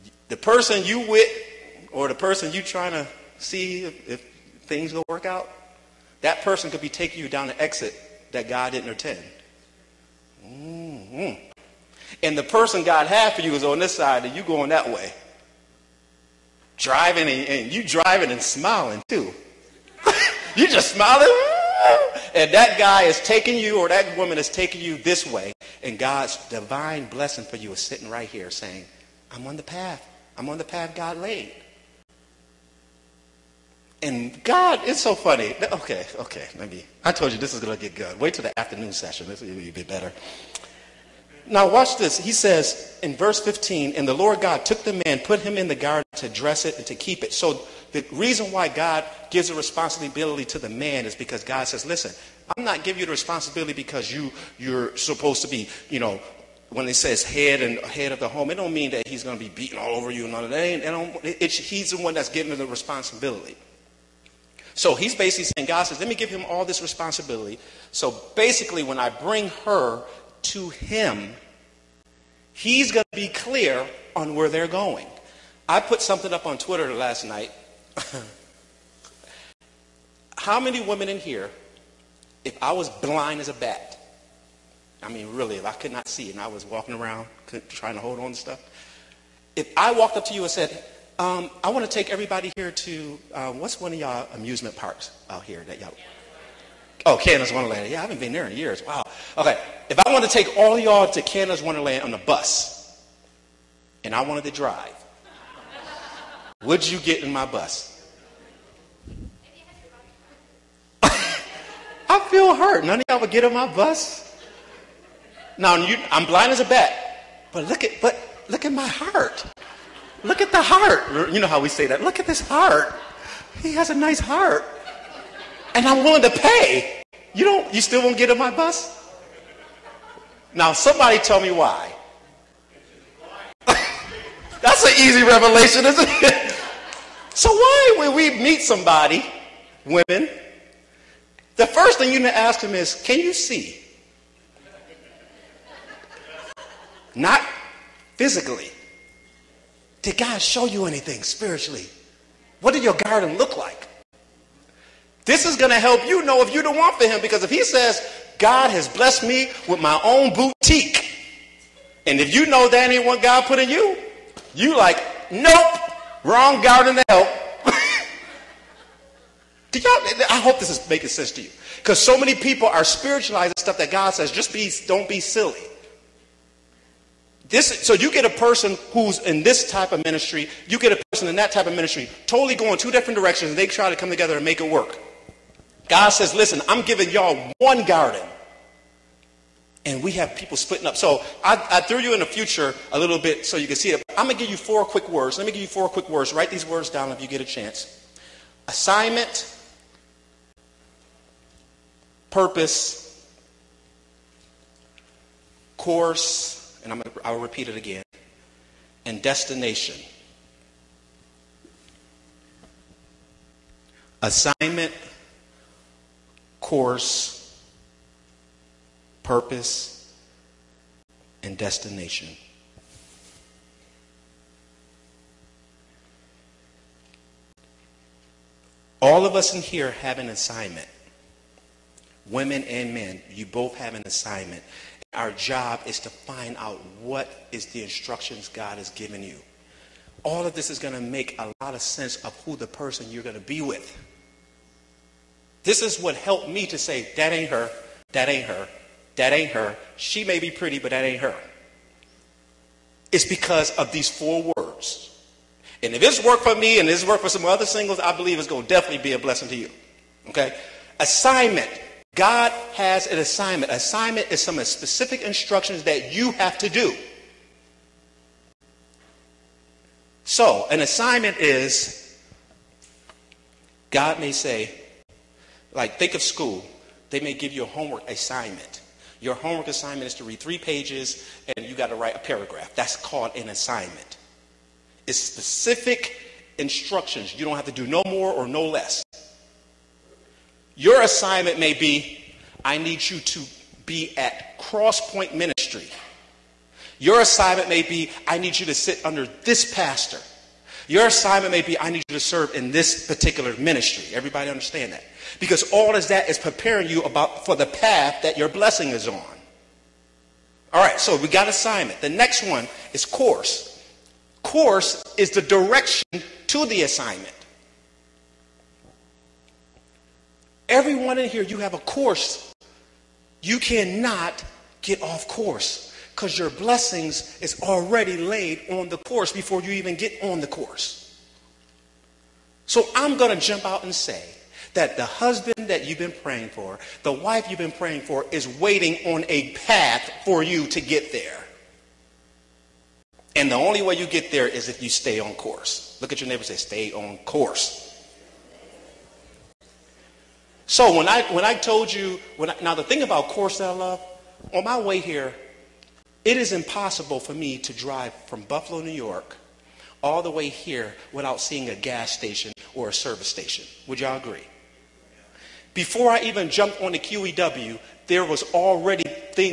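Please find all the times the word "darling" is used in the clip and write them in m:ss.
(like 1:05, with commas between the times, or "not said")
not said.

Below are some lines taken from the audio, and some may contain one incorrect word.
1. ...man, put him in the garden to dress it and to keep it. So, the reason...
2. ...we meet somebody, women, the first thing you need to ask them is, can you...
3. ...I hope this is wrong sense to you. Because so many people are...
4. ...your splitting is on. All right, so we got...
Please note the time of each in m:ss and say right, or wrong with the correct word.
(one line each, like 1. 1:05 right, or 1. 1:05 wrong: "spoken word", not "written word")
1. 0:45 right
2. 2:18 right
3. 2:50 wrong: "making", not "wrong"
4. 5:08 wrong: "blessing", not "splitting".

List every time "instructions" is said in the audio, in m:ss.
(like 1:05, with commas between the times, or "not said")
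3:57, 4:25, 4:46.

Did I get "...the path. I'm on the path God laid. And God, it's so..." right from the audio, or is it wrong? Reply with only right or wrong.
right.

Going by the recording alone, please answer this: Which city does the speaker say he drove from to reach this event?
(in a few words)
Buffalo, New York.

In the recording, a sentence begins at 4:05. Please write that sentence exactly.
This is what helped me to say, that ain't her, that ain't her, that ain't her.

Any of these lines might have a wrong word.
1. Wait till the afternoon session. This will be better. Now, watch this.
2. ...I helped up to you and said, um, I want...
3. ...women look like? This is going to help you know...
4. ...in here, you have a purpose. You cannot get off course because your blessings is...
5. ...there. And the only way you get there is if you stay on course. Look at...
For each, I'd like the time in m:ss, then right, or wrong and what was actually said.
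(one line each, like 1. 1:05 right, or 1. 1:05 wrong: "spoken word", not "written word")
1. 0:38 right
2. 1:29 wrong: "walked", not "helped"
3. 2:32 wrong: "garden", not "women"
4. 5:21 wrong: "course", not "purpose"
5. 5:41 right.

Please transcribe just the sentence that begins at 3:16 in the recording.
Write these words down if you get a chance.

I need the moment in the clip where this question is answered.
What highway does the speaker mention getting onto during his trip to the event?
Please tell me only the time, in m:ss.
6:06.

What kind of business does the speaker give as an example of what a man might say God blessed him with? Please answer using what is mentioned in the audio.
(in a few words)
boutique.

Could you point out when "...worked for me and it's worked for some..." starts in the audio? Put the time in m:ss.
4:16.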